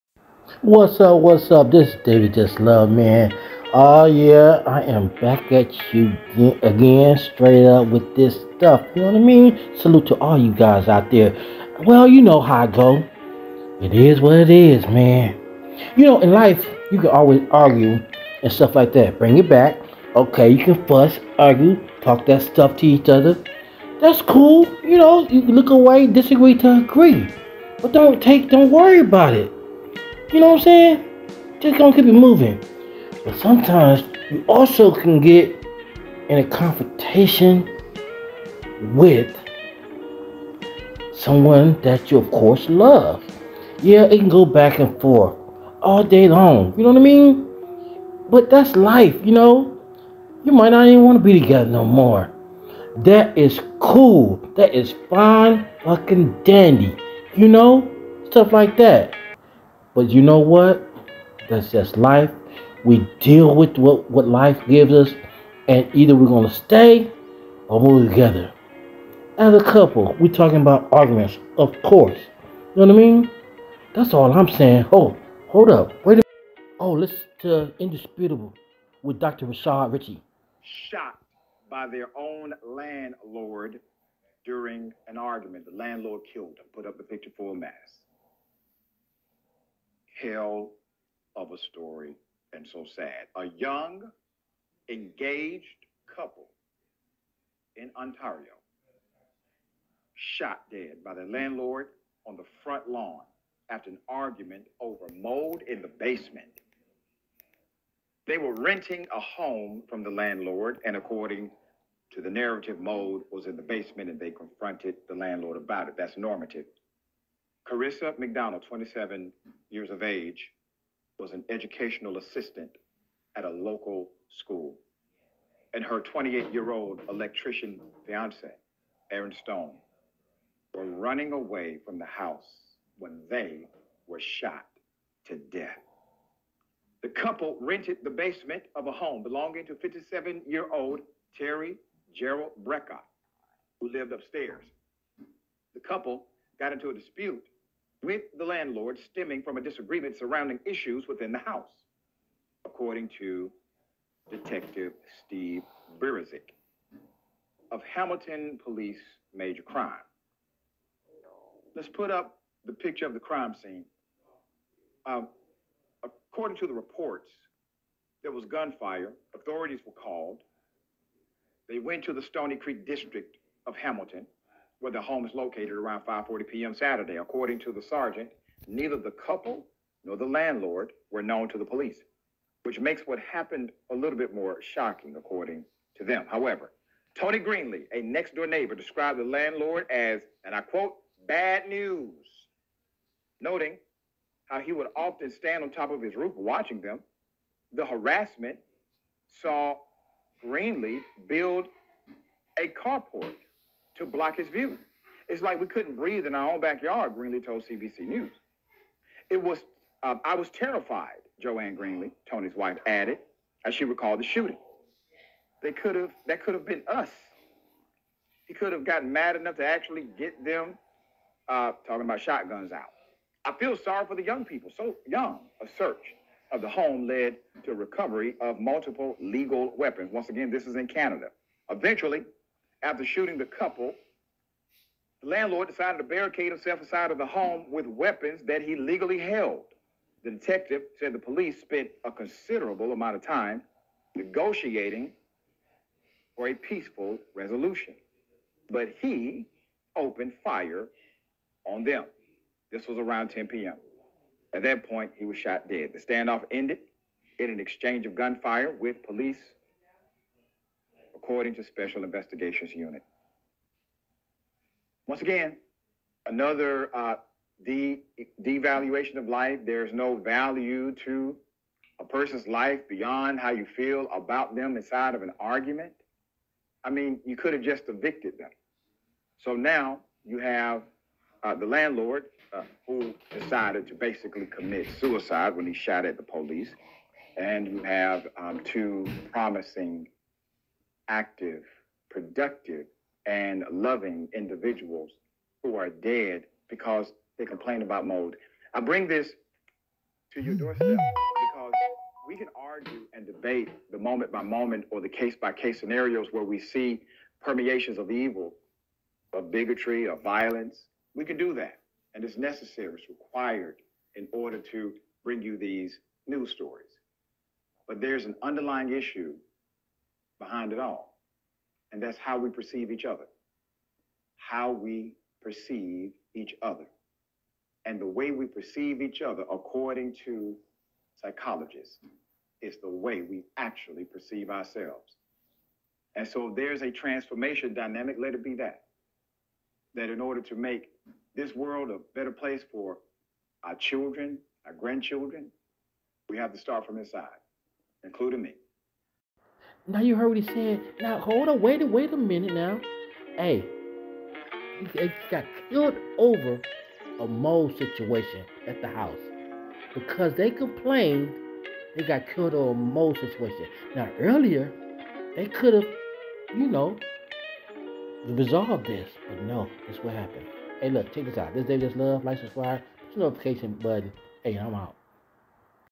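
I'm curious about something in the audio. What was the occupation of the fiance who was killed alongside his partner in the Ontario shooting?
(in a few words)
Electrician.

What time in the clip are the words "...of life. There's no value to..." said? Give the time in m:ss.
4:29.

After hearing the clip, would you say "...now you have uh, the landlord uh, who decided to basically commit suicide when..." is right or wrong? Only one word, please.
right.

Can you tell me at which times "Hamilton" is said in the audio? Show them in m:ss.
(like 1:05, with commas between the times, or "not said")
2:37, 2:53.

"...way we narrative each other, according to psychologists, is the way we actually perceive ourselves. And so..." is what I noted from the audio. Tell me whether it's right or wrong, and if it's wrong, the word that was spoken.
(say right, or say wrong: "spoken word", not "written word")
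wrong: "perceive", not "narrative".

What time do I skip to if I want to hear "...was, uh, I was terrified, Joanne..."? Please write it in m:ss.
3:29.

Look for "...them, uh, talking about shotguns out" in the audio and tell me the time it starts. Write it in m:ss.
3:40.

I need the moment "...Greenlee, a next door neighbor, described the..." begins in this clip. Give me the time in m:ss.
3:07.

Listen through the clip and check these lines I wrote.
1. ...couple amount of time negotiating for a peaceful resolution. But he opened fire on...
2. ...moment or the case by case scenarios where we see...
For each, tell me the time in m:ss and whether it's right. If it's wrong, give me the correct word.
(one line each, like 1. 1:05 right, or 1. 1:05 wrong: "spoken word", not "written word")
1. 4:02 wrong: "considerable", not "couple"
2. 5:04 right.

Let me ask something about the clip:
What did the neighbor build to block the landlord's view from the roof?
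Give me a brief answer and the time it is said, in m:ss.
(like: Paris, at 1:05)
A carport, at 3:22.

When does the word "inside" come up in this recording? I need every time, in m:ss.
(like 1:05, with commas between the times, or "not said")
3:56, 4:34, 5:46.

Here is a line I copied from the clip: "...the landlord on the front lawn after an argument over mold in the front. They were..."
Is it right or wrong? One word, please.
wrong.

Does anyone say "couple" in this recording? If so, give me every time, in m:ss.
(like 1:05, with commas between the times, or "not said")
1:09, 1:36, 2:17, 2:25, 2:59, 3:53.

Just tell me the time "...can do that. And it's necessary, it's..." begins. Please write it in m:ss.
5:11.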